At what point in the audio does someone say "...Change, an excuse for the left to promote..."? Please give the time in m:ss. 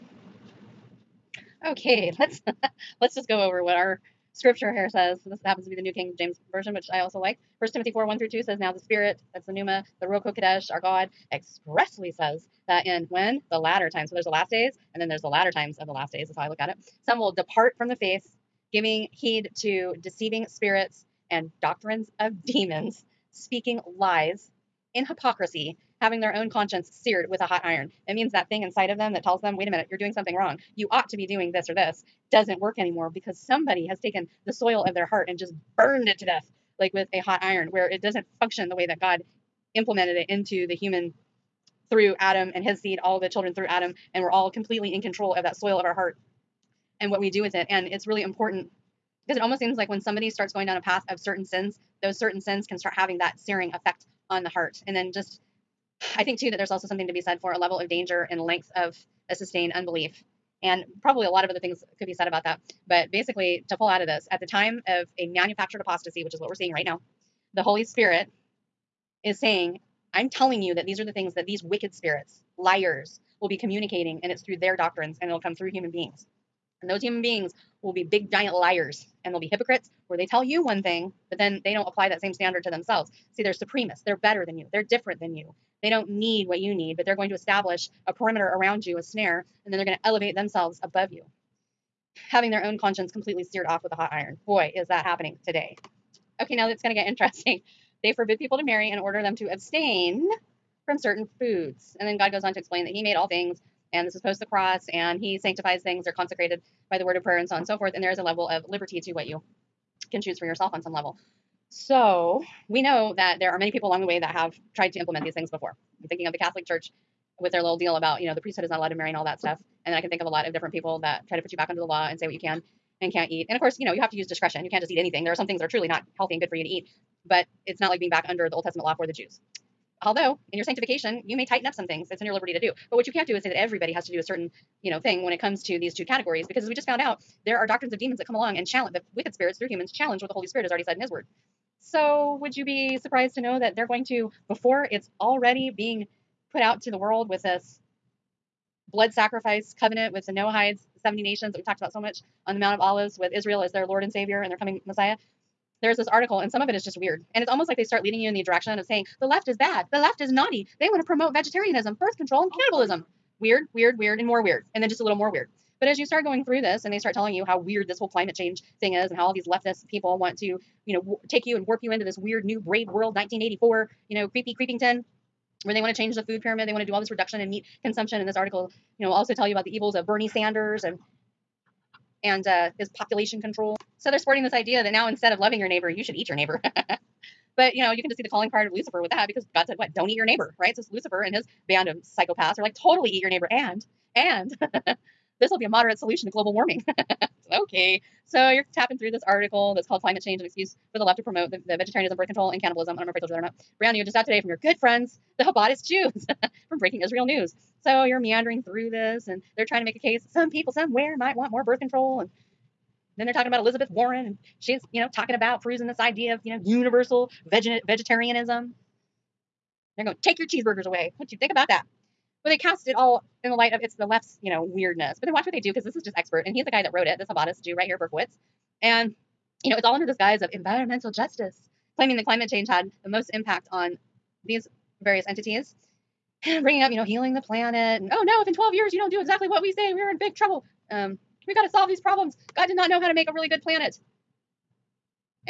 3:20.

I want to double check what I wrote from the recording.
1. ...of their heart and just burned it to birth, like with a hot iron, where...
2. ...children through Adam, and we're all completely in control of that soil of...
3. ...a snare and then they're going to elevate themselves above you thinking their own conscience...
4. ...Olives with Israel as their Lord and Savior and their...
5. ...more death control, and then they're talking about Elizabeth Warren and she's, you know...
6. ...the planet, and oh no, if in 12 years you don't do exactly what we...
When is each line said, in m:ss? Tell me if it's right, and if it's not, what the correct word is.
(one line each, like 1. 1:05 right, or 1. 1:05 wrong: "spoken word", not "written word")
1. 0:34 wrong: "death", not "birth"
2. 0:43 right
3. 1:28 wrong: "having", not "thinking"
4. 2:32 right
5. 3:31 wrong: "birth", not "death"
6. 3:57 right.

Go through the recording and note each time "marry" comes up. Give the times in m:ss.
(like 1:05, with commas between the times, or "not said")
1:38, 1:58.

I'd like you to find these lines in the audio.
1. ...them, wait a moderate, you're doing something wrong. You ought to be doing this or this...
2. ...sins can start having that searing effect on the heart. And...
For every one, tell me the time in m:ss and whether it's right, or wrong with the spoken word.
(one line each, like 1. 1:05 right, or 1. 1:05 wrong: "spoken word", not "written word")
1. 0:29 wrong: "minute", not "moderate"
2. 0:52 right.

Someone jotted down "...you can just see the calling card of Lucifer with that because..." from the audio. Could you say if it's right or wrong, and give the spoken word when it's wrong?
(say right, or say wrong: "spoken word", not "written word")
right.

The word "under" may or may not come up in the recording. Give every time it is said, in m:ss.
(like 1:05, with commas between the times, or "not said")
2:01, 2:08, 3:49.